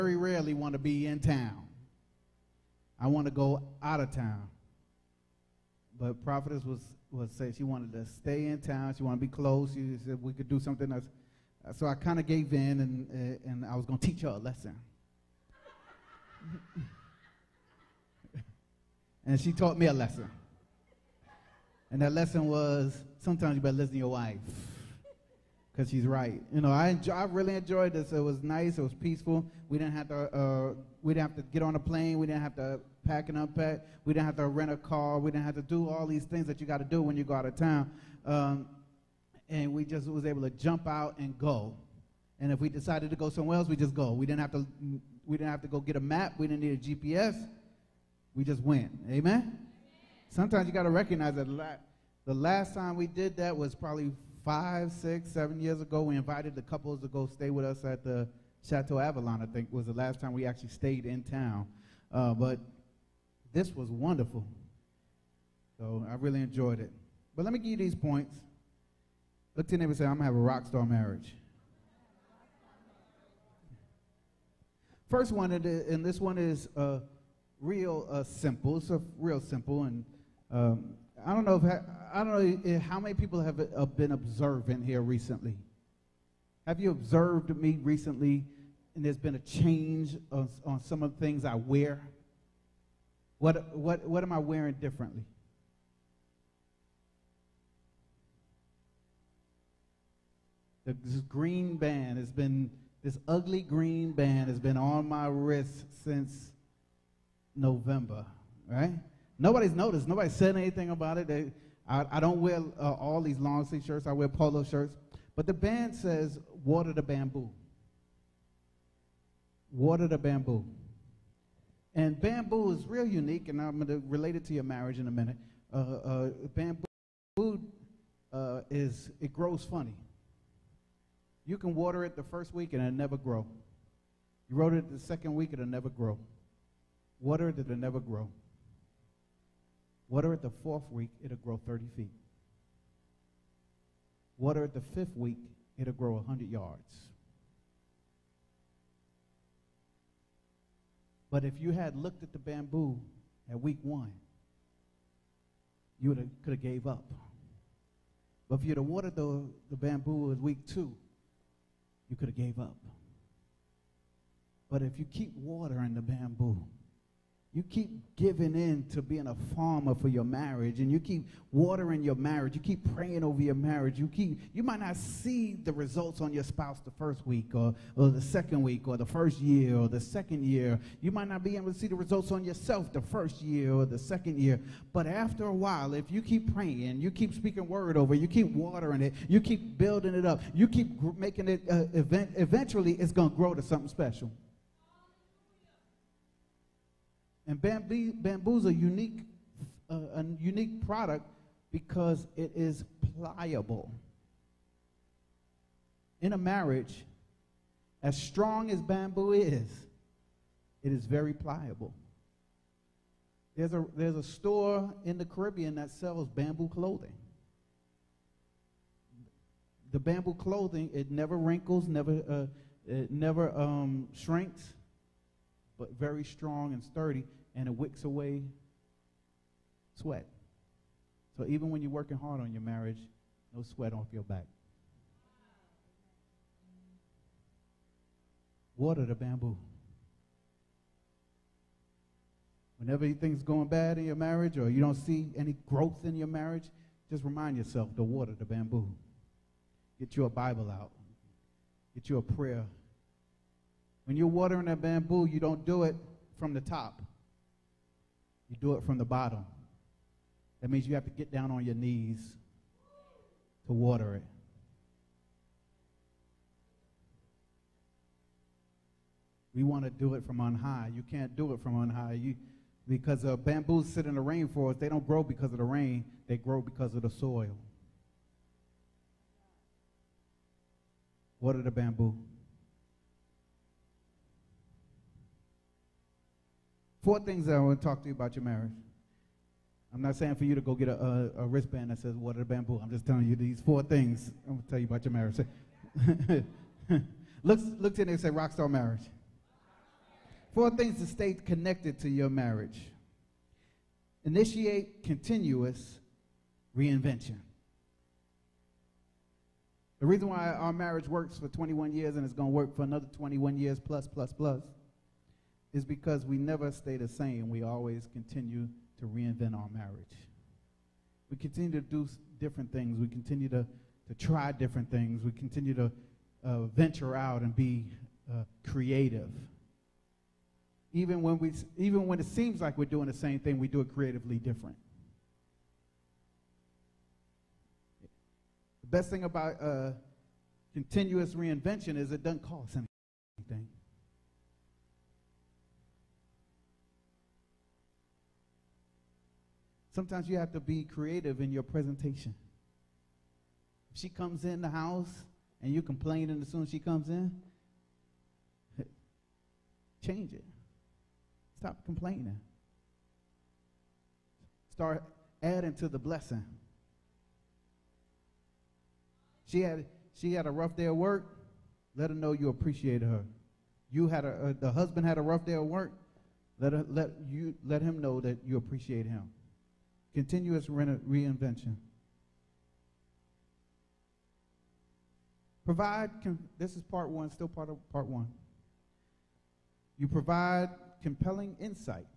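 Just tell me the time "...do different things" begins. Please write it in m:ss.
5:21.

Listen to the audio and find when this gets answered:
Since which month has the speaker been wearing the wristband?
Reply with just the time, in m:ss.
1:47.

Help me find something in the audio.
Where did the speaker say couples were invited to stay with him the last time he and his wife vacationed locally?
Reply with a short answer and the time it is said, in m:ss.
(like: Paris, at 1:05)
Chateau Avalon, at 0:58.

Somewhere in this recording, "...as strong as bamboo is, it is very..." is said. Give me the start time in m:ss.
3:28.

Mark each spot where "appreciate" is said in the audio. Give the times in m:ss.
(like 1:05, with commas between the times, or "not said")
6:12, 6:18.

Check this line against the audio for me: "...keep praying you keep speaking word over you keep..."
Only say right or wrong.
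right.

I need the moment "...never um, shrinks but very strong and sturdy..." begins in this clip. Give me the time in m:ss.
3:43.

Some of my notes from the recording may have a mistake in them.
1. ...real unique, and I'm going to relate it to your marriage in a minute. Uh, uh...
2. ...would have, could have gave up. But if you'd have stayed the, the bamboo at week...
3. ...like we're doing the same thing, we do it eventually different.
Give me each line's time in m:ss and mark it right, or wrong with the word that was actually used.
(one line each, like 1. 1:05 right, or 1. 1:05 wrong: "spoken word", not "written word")
1. 2:02 right
2. 2:36 wrong: "watered", not "stayed"
3. 5:32 wrong: "creatively", not "eventually".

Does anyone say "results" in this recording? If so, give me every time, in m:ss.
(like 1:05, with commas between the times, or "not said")
2:55, 3:01.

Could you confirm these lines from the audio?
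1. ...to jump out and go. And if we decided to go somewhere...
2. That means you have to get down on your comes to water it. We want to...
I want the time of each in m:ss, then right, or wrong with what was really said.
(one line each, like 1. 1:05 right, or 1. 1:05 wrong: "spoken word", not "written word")
1. 0:40 right
2. 4:20 wrong: "knees", not "comes".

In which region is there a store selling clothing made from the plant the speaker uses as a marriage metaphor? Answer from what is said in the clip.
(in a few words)
The Caribbean.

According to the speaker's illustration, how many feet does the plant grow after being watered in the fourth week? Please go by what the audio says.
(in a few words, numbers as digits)
30.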